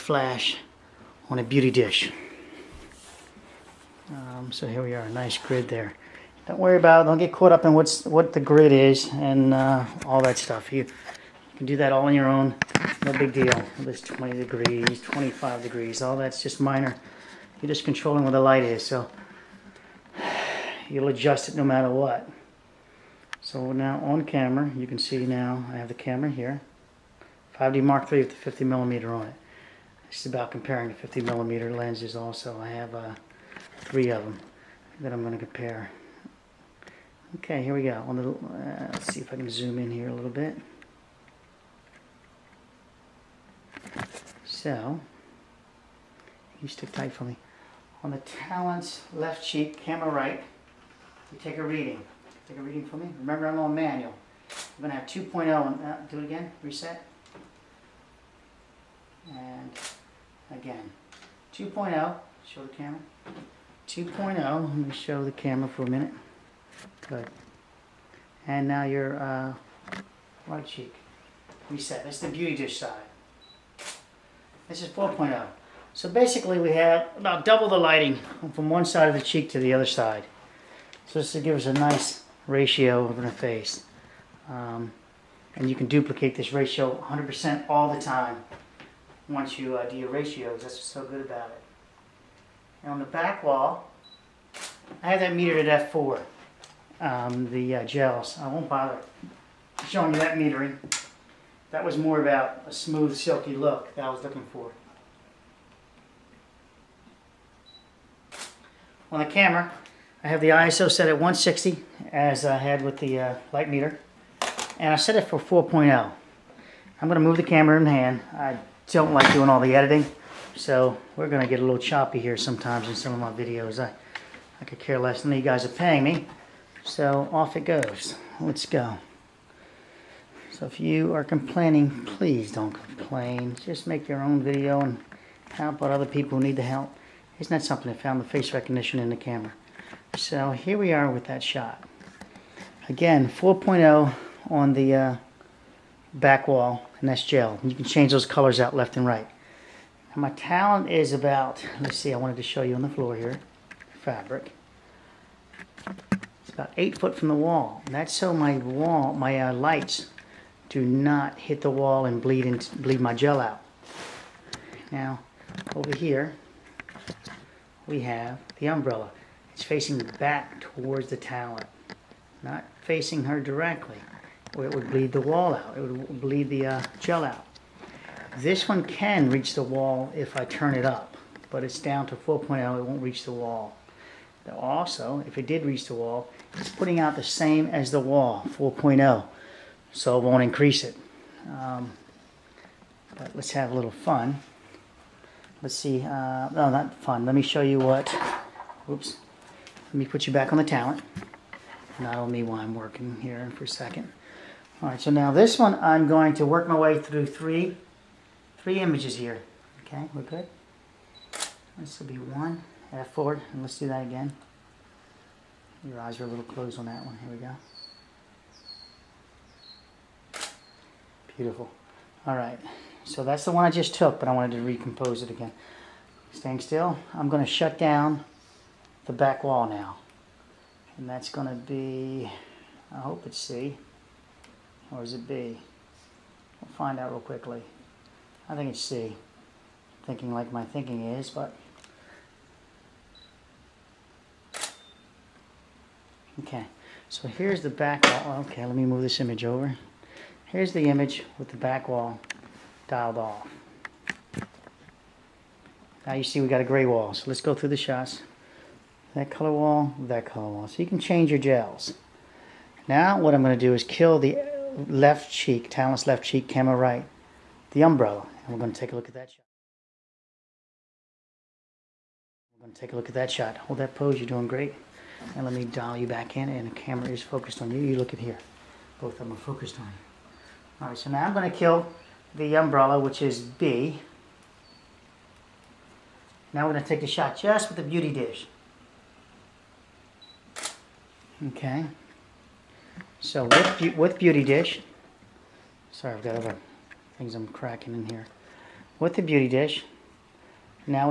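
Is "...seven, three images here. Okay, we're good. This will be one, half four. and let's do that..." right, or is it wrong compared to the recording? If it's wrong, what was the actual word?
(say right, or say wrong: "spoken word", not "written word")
wrong: "three", not "seven".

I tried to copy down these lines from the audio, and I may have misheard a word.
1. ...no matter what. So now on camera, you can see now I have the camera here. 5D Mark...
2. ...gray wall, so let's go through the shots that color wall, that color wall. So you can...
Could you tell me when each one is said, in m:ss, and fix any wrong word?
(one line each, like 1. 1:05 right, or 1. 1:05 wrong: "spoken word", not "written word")
1. 0:21 right
2. 4:16 right.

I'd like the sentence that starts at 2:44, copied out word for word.
Now, over here, we have the umbrella.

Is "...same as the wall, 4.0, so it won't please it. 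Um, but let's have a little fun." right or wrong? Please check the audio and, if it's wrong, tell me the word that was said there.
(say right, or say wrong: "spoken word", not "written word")
wrong: "increase", not "please".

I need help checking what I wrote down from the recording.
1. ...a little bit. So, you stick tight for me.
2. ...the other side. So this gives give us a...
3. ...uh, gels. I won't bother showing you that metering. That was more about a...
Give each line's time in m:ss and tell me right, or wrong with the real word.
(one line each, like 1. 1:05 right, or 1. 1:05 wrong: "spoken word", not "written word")
1. 0:40 right
2. 1:19 right
3. 1:37 right.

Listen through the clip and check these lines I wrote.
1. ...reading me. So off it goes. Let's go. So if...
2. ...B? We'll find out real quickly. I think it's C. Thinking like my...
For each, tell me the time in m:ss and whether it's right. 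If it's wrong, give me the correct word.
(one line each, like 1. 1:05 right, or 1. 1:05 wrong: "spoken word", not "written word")
1. 2:05 wrong: "paying", not "reading"
2. 3:55 right.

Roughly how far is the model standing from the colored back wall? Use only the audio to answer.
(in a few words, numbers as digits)
8 feet.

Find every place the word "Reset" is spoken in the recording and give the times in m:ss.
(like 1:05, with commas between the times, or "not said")
0:56, 1:11.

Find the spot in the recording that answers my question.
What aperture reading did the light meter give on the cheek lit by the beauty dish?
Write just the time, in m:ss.
1:14.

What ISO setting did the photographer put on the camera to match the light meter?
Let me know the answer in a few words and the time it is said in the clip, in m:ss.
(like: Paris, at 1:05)
160, at 1:51.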